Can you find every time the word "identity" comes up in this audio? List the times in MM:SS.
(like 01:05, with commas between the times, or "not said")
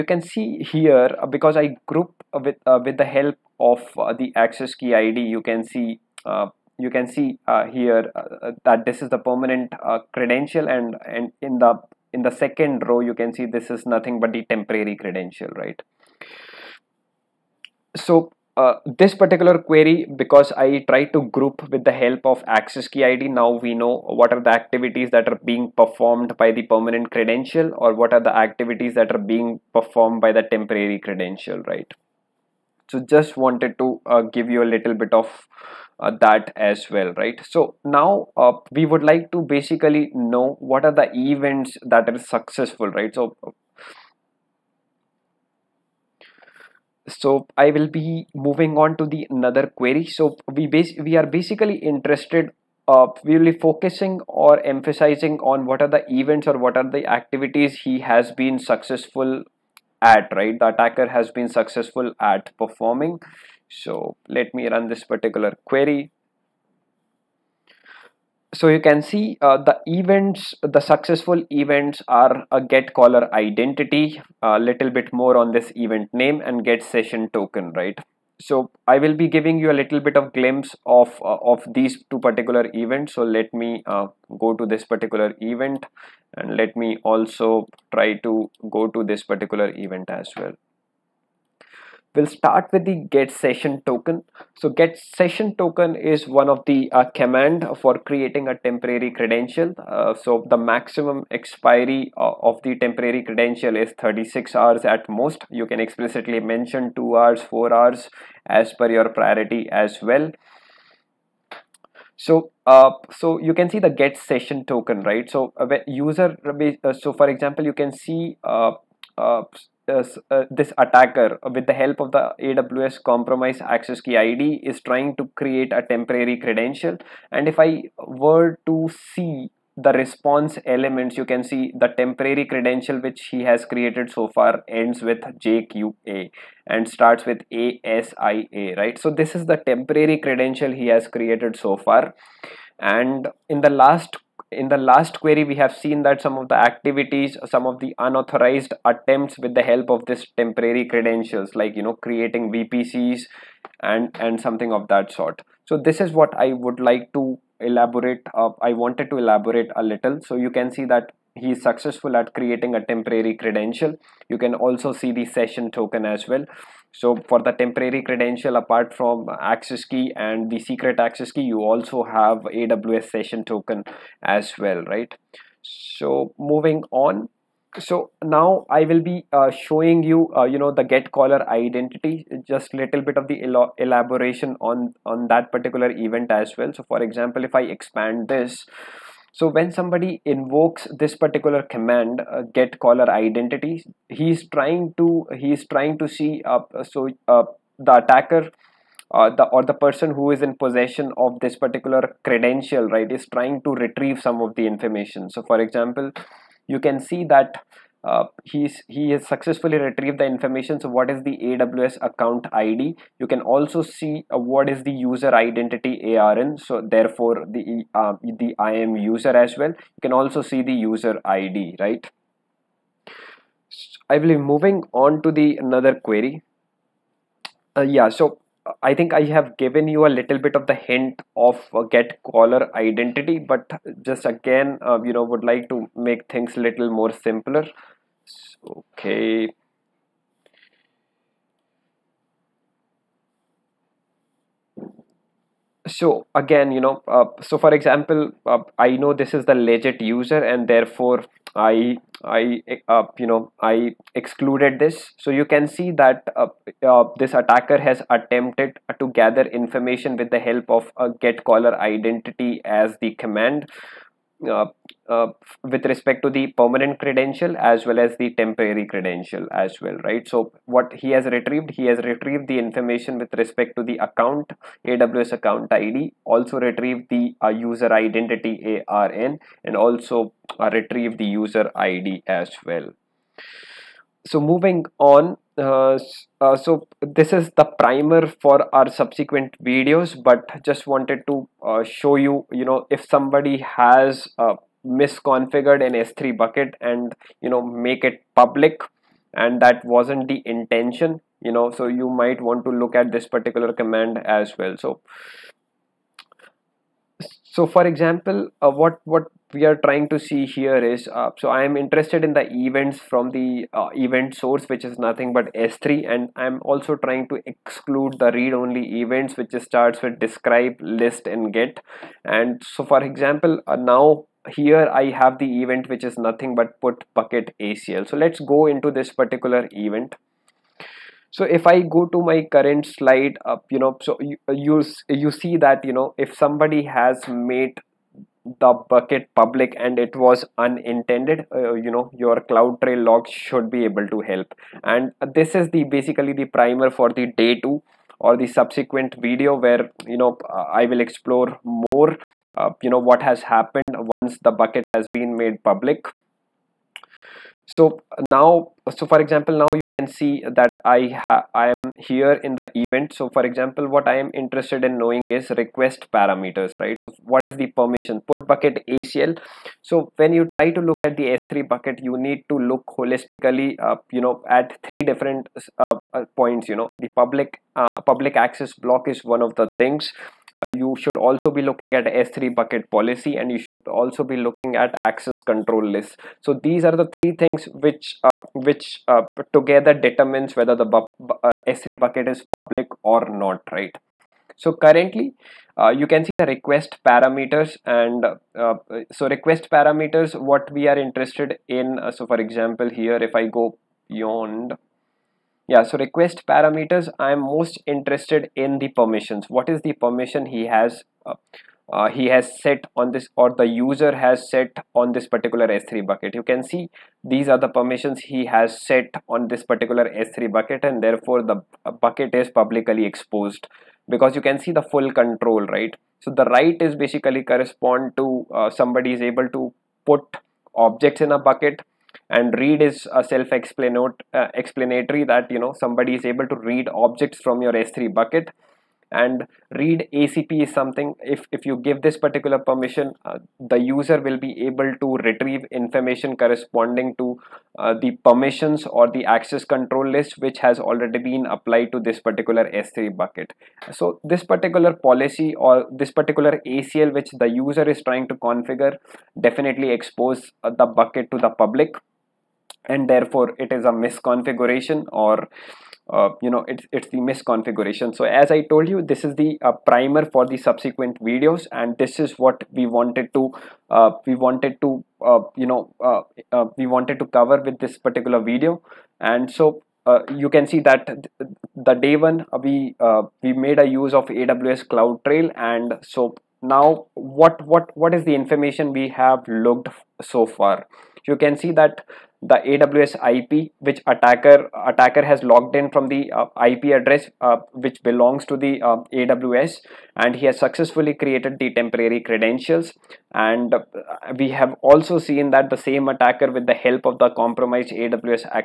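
01:13, 03:01, 03:13, 03:35, 03:52, 04:21, 04:37.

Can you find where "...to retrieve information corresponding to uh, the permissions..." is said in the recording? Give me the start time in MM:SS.
07:24.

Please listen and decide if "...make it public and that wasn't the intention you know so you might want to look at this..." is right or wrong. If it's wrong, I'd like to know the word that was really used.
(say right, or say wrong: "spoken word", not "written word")
right.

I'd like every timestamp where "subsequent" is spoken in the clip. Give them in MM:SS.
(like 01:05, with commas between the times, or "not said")
04:48, 05:48, 07:50.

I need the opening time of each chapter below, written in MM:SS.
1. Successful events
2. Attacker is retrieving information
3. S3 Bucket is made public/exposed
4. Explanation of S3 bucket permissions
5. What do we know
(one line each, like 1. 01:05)
1. 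00:46
2. 03:44
3. 04:43
4. 06:51
5. 08:06.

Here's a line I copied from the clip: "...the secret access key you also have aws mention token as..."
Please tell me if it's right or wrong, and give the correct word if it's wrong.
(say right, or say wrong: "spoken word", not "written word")
wrong: "session", not "mention".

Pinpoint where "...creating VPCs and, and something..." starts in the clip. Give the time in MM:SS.
02:31.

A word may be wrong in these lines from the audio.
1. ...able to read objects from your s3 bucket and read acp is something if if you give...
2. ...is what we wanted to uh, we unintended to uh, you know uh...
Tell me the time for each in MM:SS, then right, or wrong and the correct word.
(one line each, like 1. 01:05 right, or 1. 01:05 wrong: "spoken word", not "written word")
1. 07:16 right
2. 07:52 wrong: "wanted", not "unintended".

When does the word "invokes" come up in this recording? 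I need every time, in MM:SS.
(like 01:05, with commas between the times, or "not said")
03:10.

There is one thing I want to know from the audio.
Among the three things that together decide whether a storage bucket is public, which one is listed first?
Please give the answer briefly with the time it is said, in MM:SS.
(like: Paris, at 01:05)
public access block, at 06:17.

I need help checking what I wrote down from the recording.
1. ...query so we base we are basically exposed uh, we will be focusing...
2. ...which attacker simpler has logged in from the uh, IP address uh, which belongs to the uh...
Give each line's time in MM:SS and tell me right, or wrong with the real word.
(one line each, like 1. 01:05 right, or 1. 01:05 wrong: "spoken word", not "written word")
1. 00:49 wrong: "interested", not "exposed"
2. 08:13 wrong: "attacker", not "simpler".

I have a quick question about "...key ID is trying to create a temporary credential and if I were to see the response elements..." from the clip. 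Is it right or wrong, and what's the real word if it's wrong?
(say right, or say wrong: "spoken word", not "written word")
right.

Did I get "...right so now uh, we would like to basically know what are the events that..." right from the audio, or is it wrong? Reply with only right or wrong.
right.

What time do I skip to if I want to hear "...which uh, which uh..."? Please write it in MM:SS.
06:27.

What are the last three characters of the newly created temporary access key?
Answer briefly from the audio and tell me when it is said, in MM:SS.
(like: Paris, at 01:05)
jqa, at 02:15.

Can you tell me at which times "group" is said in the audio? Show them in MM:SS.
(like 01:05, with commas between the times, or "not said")
00:01, 00:21.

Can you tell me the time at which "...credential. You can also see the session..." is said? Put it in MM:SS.
02:43.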